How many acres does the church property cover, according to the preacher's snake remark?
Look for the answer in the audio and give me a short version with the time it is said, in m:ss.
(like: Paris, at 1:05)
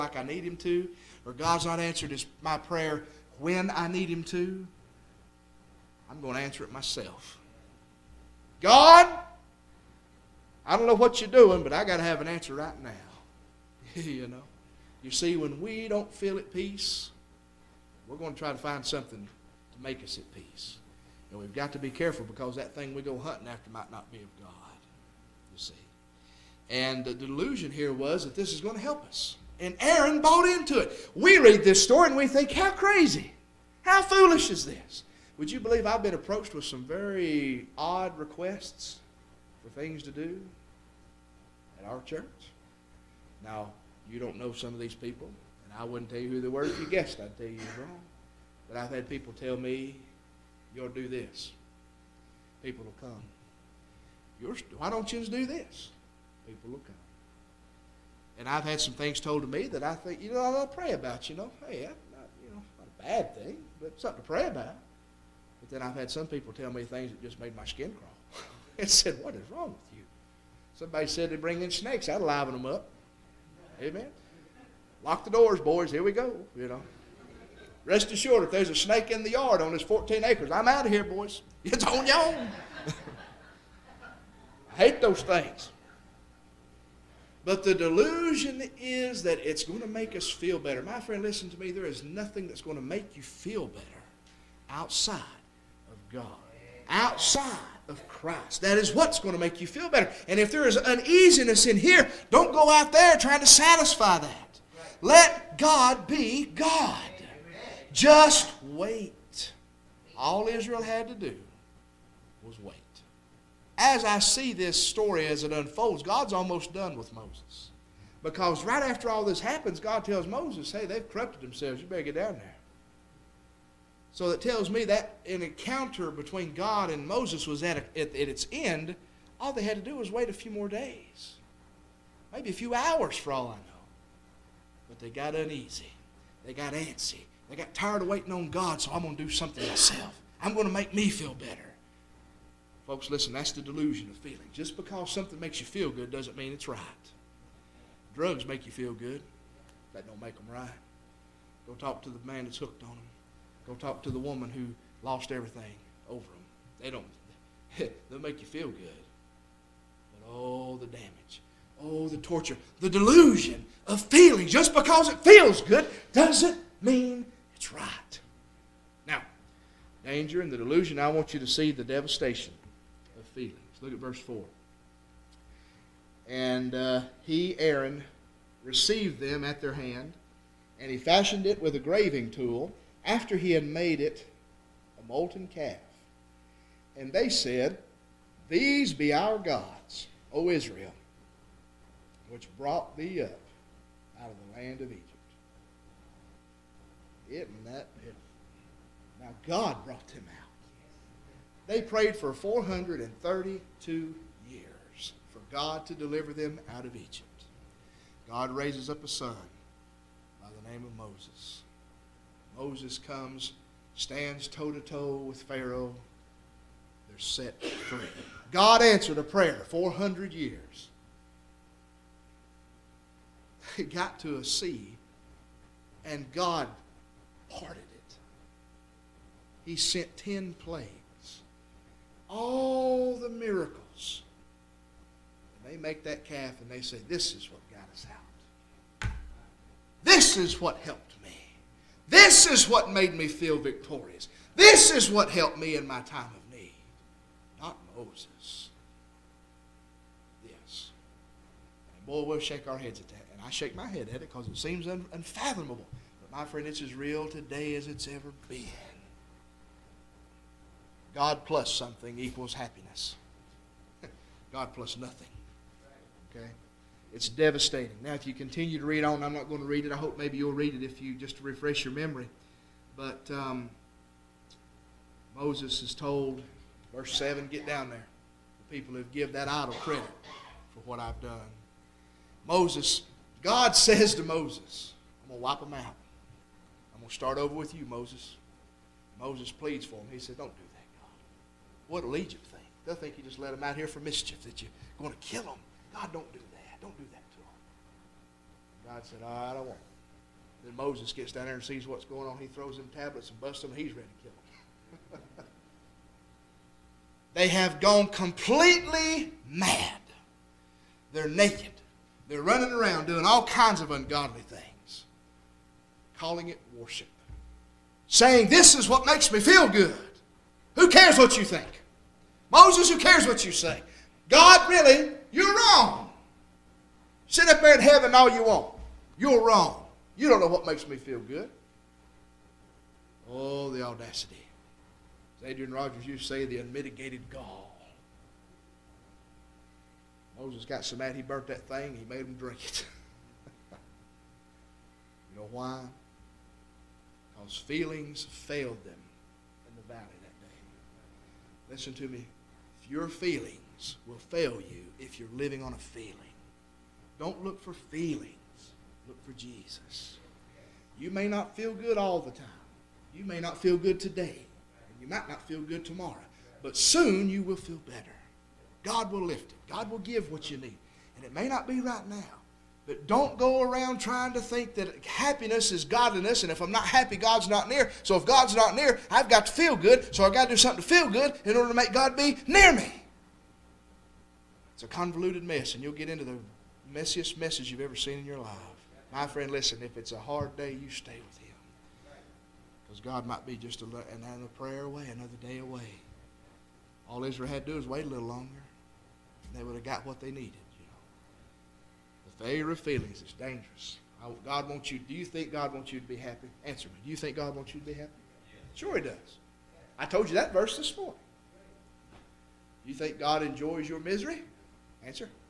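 14, at 1:19.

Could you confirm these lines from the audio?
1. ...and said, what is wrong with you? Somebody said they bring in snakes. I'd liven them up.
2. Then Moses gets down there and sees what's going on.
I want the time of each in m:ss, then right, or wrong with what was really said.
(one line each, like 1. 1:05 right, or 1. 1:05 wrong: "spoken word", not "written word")
1. 1:08 right
2. 5:00 right.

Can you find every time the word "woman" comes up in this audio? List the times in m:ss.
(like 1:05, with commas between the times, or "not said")
2:34.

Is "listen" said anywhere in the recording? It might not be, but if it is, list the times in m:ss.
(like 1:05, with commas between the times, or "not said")
1:31, 2:23, 5:51, 6:29.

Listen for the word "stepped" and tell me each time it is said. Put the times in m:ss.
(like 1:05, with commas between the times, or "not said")
not said.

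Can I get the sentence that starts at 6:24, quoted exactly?
It's a convoluted mess, and you'll get into the messiest messes you've ever seen in your life.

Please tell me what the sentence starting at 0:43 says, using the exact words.
Now, you don't know some of these people, and I wouldn't tell you who they were if you guessed.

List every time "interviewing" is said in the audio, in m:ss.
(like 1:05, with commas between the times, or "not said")
not said.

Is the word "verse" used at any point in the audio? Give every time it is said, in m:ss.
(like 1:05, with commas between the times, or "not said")
2:53, 4:36, 6:50.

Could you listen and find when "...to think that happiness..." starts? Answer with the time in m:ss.
6:14.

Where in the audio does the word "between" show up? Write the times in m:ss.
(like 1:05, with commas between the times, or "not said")
2:06.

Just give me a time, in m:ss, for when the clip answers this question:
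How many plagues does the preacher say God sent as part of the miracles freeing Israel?
3:50.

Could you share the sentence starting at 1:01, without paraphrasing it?
Hey, not, you know, not a bad thing, but something to pray about.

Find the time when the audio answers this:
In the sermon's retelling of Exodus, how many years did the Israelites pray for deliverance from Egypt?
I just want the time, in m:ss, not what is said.
3:22.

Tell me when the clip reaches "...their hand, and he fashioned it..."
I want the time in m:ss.
2:59.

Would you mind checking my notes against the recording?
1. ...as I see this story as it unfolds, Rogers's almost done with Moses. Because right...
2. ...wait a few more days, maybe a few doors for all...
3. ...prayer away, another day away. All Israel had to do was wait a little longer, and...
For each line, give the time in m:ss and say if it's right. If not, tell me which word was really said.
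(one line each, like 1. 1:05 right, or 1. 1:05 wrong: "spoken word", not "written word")
1. 1:53 wrong: "God", not "Rogers"
2. 2:10 wrong: "hours", not "doors"
3. 6:34 right.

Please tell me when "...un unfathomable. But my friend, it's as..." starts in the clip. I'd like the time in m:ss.
4:14.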